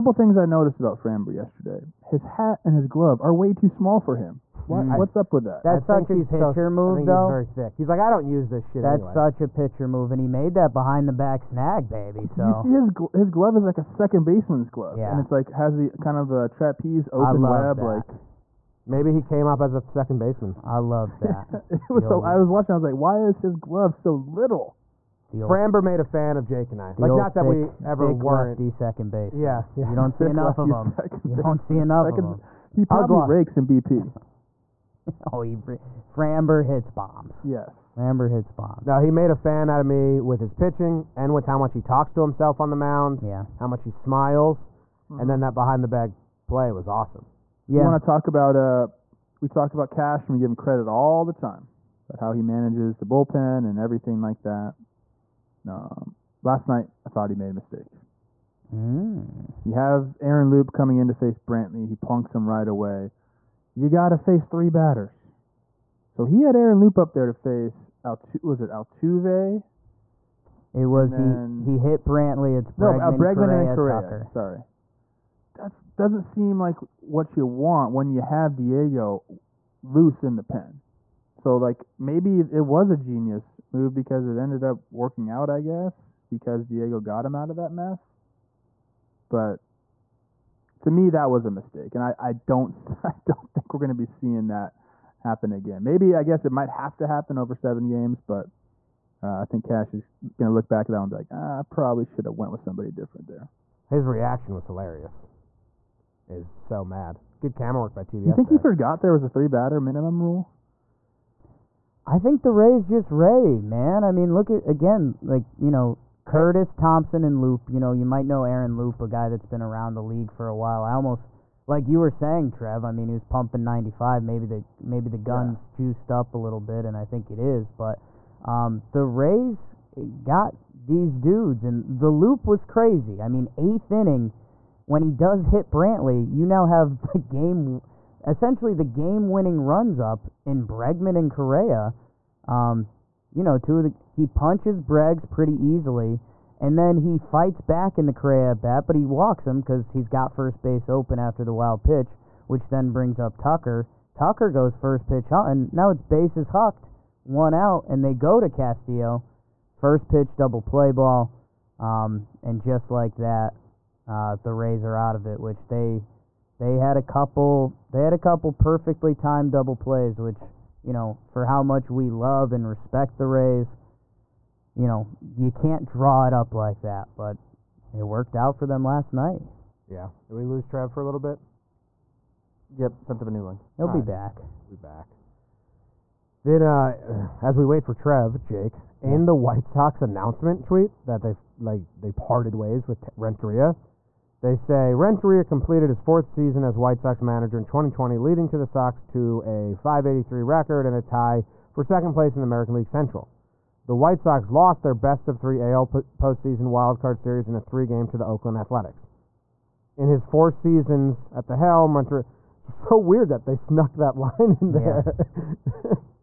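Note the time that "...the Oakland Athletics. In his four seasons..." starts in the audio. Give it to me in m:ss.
3:28.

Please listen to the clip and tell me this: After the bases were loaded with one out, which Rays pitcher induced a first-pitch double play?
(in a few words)
Castillo.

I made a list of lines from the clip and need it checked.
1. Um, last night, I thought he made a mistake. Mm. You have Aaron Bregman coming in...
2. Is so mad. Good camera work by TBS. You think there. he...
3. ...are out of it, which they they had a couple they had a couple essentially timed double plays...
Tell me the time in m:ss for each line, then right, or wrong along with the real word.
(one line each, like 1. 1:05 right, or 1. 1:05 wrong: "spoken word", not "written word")
1. 0:55 wrong: "Loup", not "Bregman"
2. 1:46 right
3. 2:44 wrong: "perfectly", not "essentially".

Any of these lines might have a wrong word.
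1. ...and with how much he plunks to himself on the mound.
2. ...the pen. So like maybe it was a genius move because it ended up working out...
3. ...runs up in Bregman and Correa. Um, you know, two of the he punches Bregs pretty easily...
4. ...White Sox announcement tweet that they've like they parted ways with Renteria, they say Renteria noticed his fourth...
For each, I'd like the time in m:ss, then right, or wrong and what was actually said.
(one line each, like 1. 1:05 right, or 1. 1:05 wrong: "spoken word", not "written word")
1. 0:41 wrong: "talks", not "plunks"
2. 1:20 right
3. 2:19 right
4. 3:09 wrong: "completed", not "noticed".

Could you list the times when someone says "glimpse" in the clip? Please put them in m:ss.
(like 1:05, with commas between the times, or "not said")
not said.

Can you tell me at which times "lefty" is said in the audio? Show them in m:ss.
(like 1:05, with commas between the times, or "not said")
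0:28.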